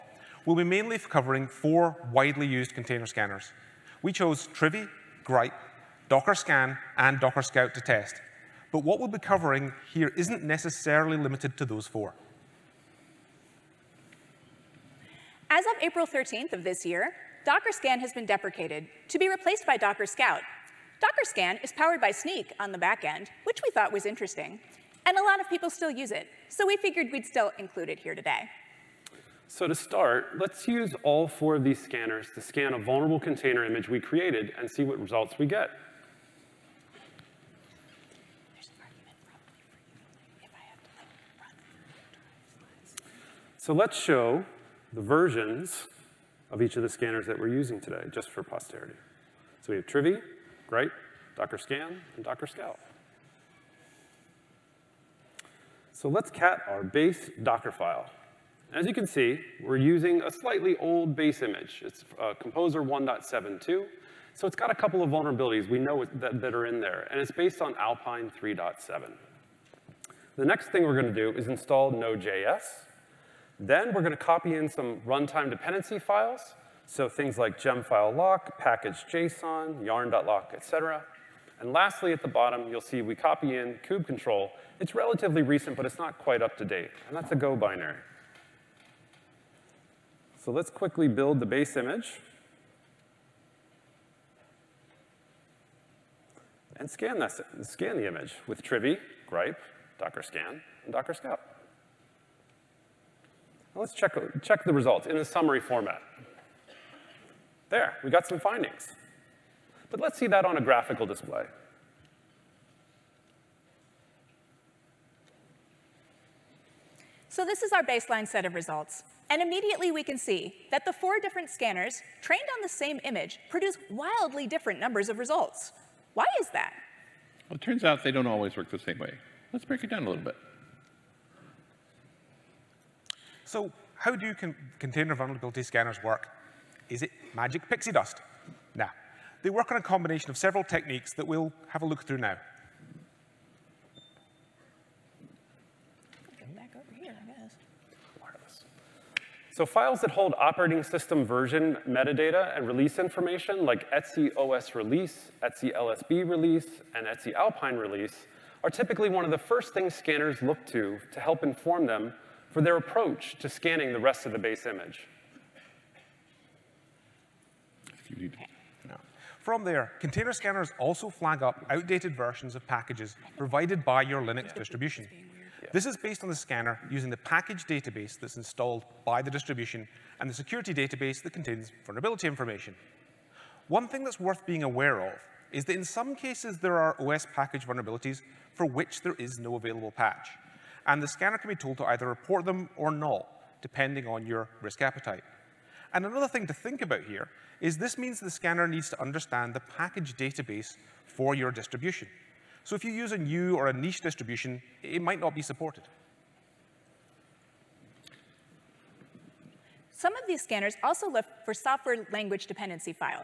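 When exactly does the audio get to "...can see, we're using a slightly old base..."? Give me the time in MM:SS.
00:58.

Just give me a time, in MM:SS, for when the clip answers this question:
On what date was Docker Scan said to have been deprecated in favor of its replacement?
00:15.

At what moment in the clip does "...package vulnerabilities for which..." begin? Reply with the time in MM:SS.
03:07.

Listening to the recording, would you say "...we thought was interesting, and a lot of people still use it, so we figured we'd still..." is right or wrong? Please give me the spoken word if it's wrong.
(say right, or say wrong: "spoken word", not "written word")
right.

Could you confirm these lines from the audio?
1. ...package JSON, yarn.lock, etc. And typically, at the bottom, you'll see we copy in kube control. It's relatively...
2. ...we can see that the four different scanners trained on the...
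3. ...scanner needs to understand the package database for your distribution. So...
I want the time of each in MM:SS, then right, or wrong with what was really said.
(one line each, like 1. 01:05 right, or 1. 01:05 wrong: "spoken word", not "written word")
1. 01:18 wrong: "lastly", not "typically"
2. 01:59 right
3. 03:18 right.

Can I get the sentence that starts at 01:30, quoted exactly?
So let's quickly build the base image.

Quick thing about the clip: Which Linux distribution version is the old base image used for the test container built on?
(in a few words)
Alpine 3.7.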